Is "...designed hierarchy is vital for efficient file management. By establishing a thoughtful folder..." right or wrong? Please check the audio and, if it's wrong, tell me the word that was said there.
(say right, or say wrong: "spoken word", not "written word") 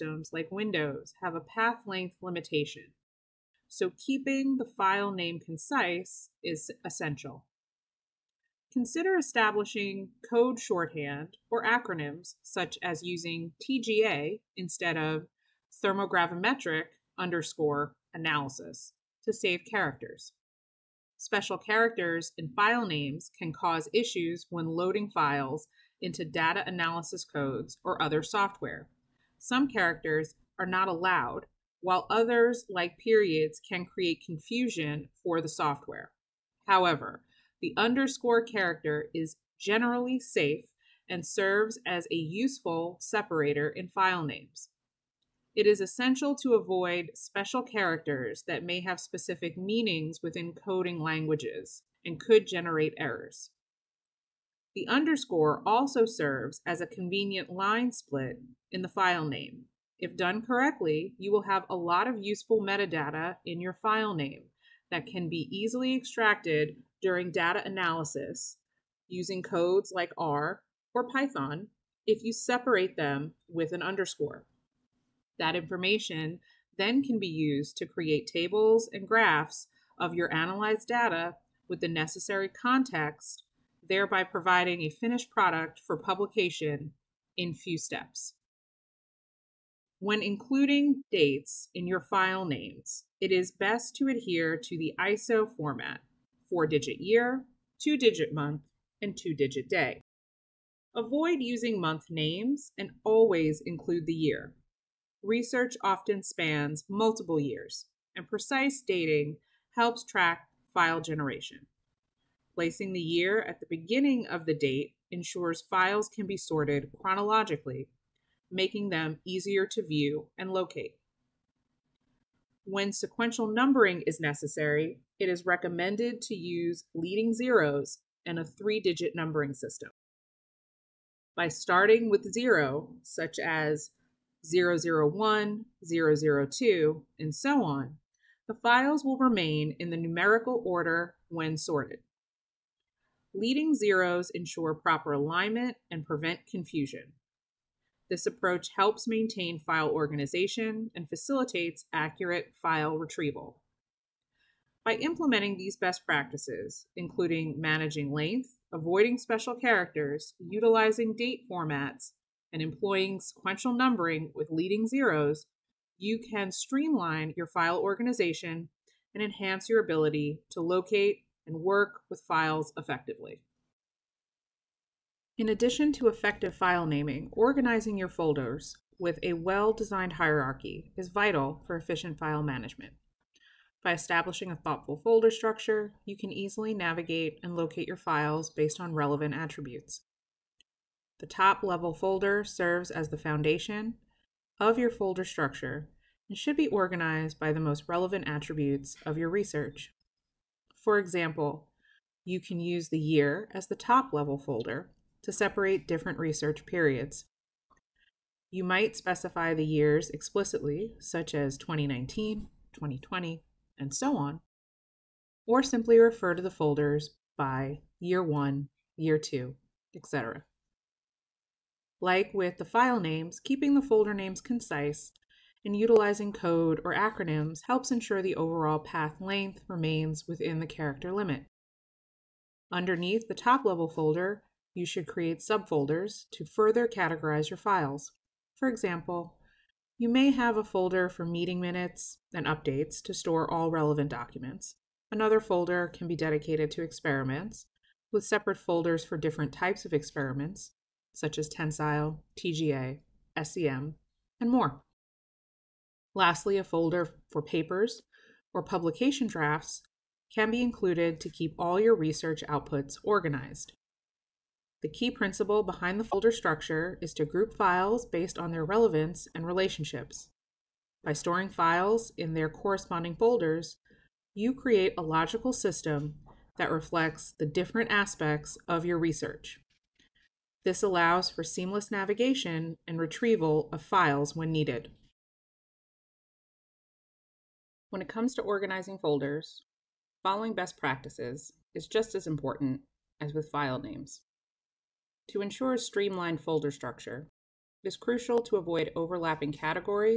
right.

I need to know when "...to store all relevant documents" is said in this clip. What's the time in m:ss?
4:03.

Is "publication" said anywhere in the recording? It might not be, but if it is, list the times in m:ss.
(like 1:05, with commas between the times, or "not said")
1:25, 4:18.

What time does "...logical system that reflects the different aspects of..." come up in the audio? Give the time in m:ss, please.
4:35.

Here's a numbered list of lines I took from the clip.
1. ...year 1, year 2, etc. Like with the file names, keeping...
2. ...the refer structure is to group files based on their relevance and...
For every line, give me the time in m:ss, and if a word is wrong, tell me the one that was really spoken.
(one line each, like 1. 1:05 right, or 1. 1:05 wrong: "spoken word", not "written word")
1. 3:37 right
2. 4:25 wrong: "folder", not "refer".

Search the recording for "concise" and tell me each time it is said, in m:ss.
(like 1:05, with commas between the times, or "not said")
0:05, 3:44.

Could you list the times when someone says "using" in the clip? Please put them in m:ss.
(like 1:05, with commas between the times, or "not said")
0:13, 1:09, 1:41.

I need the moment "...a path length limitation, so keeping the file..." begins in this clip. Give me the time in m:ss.
0:01.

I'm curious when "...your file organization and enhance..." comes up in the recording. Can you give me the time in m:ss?
2:47.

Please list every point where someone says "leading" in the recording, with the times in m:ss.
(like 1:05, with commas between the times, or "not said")
2:06, 2:23, 2:44.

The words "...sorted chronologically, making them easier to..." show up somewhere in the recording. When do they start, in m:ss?
1:56.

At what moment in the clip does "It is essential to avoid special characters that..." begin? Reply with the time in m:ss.
0:45.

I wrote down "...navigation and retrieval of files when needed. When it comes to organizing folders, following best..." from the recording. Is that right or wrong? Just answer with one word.
right.